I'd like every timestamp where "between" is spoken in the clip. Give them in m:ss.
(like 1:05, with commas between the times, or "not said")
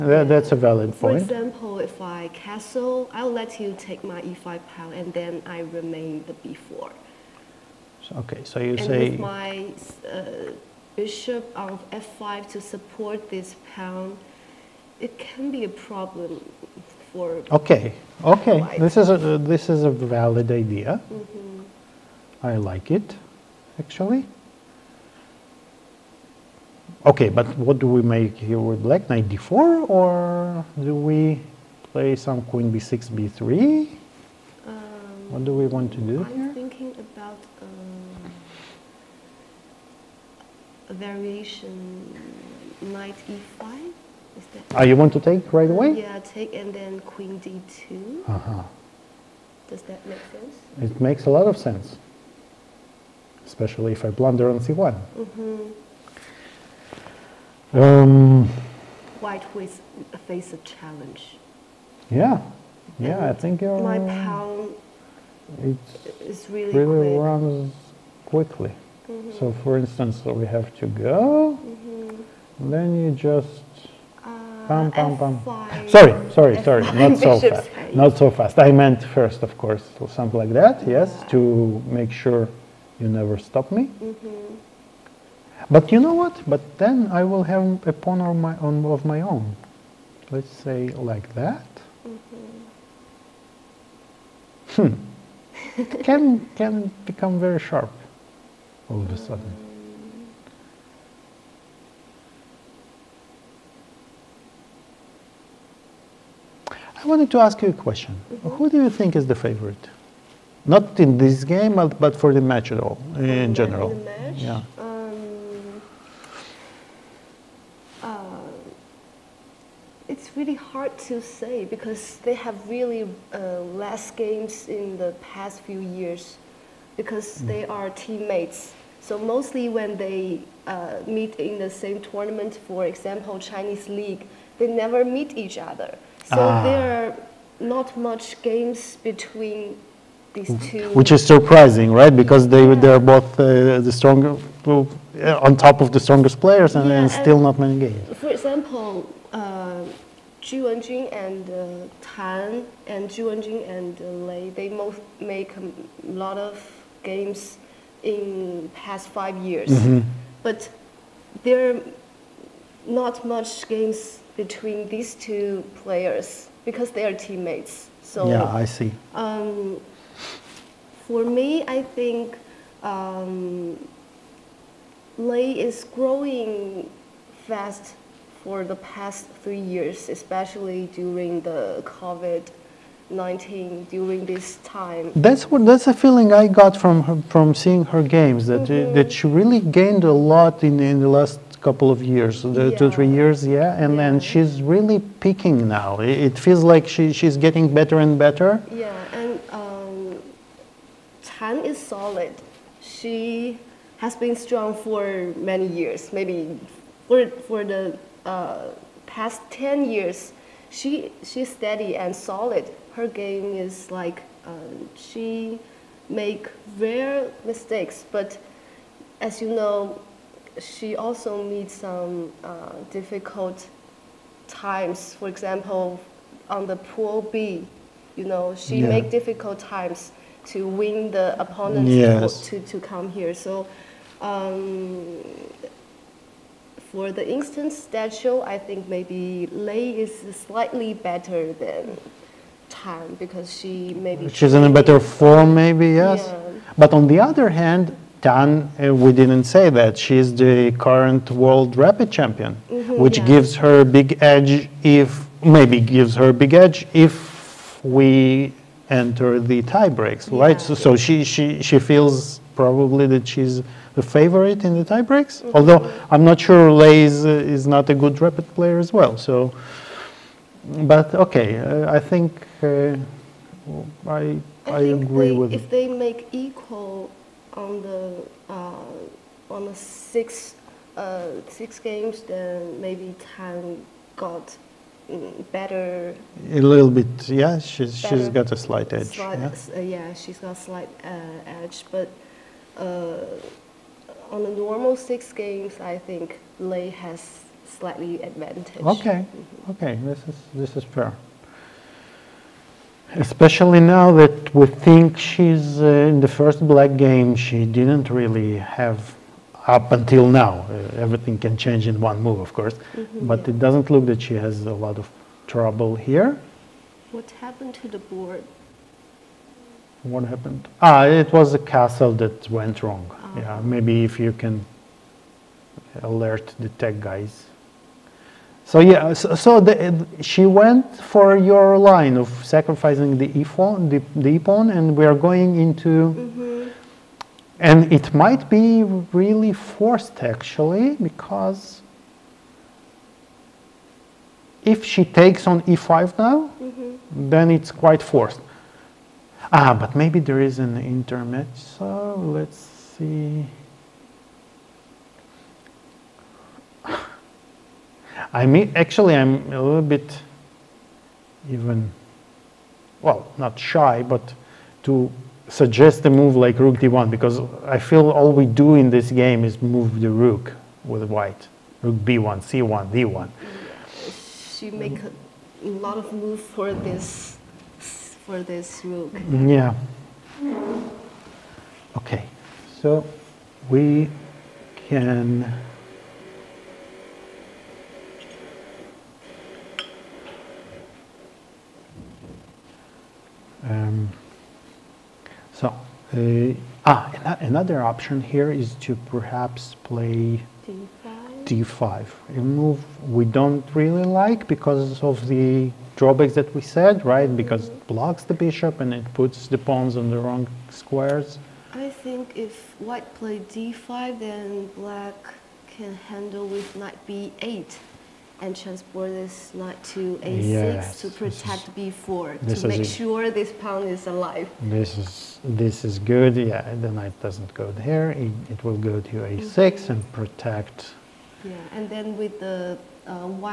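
2:19, 2:44.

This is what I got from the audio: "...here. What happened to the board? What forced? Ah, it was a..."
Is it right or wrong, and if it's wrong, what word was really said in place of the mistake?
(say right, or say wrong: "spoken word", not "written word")
wrong: "happened", not "forced".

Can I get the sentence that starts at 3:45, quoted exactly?
For example, on the pool B, you know, she yeah.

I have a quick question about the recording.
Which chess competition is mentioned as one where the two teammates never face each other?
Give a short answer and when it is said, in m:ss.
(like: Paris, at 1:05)
Chinese League, at 2:13.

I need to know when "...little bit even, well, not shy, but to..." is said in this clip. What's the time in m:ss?
5:59.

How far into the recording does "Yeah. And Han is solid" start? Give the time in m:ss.
3:18.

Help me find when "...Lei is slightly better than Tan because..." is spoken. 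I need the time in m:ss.
3:59.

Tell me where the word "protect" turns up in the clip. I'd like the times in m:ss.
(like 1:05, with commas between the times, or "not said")
7:01, 7:10.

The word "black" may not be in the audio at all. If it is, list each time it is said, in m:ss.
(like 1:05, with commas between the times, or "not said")
0:28, 5:06, 6:54.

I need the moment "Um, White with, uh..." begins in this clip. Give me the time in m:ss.
0:57.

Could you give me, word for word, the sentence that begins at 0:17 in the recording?
Okay, okay, this is a, this is a valid idea.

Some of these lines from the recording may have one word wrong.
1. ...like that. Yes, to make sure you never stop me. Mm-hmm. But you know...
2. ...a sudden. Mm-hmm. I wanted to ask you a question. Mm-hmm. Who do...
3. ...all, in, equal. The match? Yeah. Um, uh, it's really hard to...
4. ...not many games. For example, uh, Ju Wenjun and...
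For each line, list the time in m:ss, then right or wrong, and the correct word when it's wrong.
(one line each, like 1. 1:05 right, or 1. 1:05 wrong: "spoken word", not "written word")
1. 1:20 right
2. 1:39 right
3. 1:52 wrong: "general", not "equal"
4. 2:27 right.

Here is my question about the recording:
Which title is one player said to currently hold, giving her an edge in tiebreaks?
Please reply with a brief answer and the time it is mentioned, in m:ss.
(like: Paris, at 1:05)
world rapid champion, at 4:11.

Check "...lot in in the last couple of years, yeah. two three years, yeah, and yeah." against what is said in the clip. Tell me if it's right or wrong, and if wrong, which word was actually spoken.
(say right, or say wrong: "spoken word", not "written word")
right.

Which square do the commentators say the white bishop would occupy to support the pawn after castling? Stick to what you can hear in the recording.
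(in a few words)
F5.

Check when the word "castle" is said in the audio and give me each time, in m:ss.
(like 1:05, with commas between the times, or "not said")
0:02, 5:21.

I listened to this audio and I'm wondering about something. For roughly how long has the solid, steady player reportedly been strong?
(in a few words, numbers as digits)
10 years.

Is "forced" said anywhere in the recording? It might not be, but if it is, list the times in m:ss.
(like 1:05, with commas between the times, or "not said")
5:39, 5:48.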